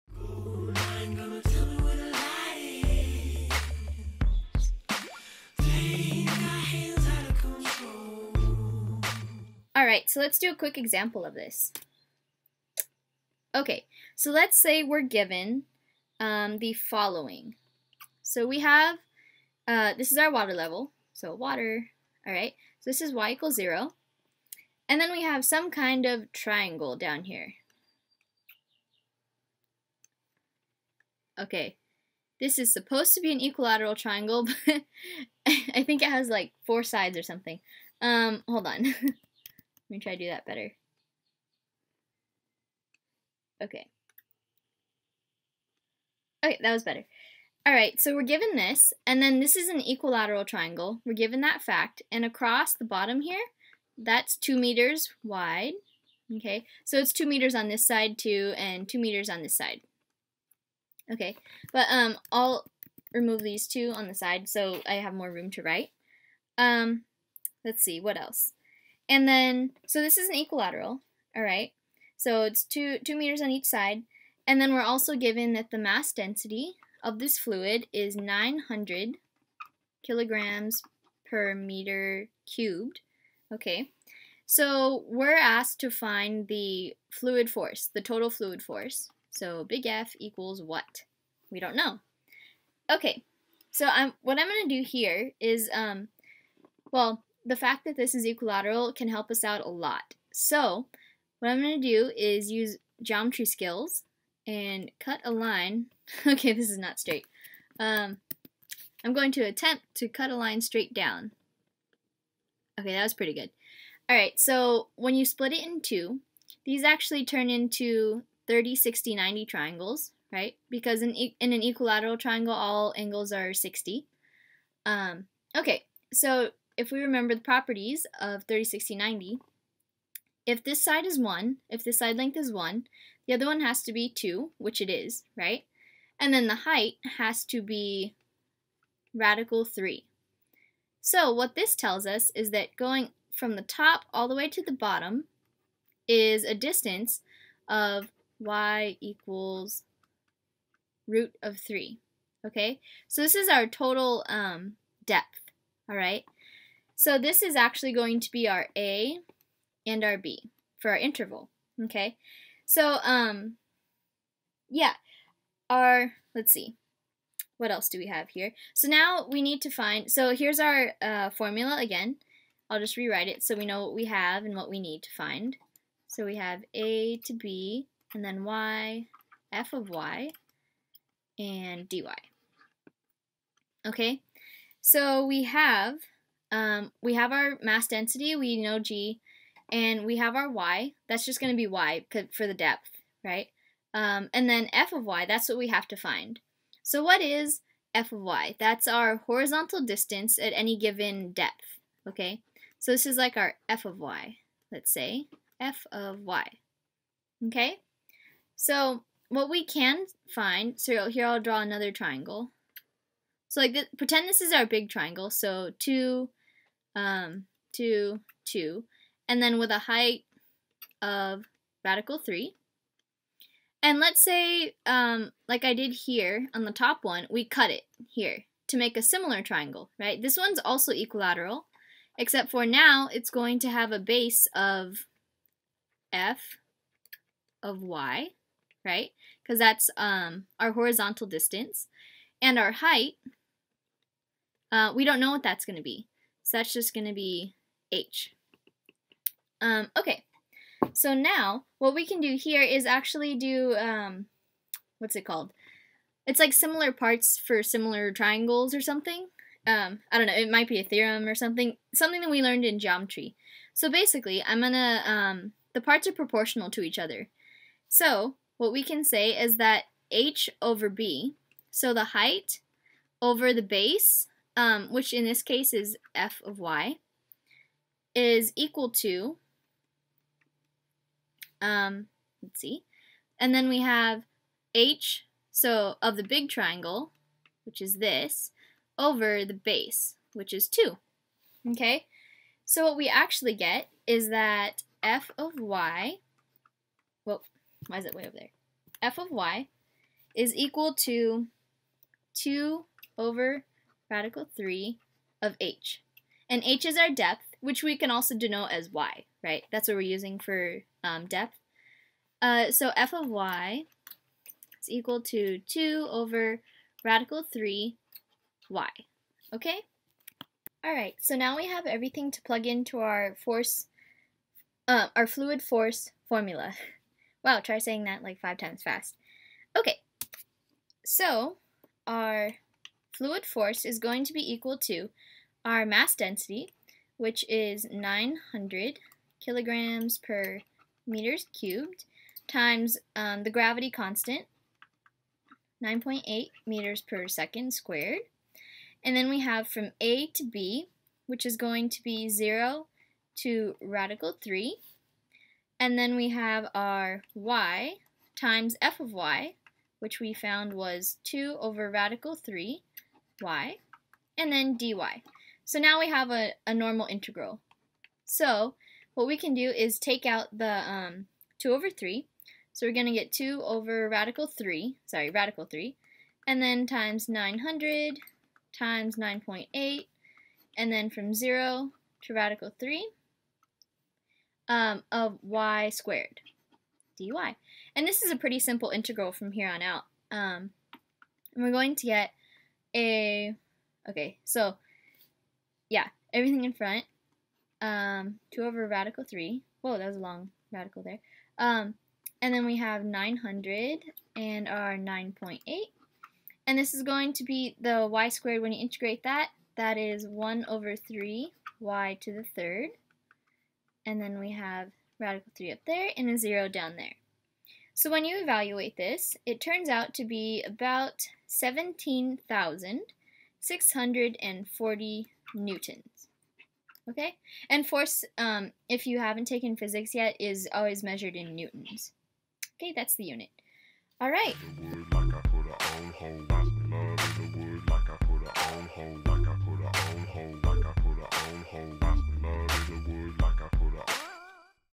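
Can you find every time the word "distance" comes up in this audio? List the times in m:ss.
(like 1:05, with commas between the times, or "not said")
2:26, 3:19, 4:01.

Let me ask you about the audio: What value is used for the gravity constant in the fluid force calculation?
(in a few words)
9.8 m/s².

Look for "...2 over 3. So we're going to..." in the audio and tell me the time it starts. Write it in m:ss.
6:11.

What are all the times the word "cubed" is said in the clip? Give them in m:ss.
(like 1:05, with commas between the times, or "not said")
1:22, 5:41.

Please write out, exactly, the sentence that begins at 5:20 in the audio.
Alright, so now we have everything to plug into our force, uh, our fluid force formula.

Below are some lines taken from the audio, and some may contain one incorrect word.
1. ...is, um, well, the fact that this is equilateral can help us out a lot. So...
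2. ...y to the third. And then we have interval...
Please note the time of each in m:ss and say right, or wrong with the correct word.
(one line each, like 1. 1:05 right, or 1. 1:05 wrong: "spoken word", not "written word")
1. 1:35 right
2. 6:51 wrong: "radical", not "interval".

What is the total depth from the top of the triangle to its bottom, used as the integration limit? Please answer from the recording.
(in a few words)
root 3.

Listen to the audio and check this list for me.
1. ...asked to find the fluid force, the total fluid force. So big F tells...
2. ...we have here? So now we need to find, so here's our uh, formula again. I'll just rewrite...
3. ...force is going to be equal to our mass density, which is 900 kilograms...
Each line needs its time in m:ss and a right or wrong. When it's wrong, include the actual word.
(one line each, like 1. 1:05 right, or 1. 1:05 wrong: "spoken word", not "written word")
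1. 1:25 wrong: "equals", not "tells"
2. 2:47 right
3. 5:33 right.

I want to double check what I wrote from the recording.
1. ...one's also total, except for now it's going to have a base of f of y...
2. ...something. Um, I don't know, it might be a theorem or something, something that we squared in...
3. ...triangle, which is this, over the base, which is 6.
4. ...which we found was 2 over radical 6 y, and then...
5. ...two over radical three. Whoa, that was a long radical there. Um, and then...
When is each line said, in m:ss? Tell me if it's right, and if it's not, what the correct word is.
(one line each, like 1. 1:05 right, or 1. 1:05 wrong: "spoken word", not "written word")
1. 3:50 wrong: "equilateral", not "total"
2. 4:18 wrong: "learned", not "squared"
3. 4:46 wrong: "2", not "6"
4. 5:59 wrong: "3", not "6"
5. 6:38 right.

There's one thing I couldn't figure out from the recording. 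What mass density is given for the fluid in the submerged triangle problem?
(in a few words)
900 kg/m³.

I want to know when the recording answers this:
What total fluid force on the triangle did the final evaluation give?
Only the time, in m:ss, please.
7:01.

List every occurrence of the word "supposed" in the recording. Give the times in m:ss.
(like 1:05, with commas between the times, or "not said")
0:32.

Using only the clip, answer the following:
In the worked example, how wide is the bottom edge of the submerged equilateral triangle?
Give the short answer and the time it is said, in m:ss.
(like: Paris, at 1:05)
2 meters, at 0:54.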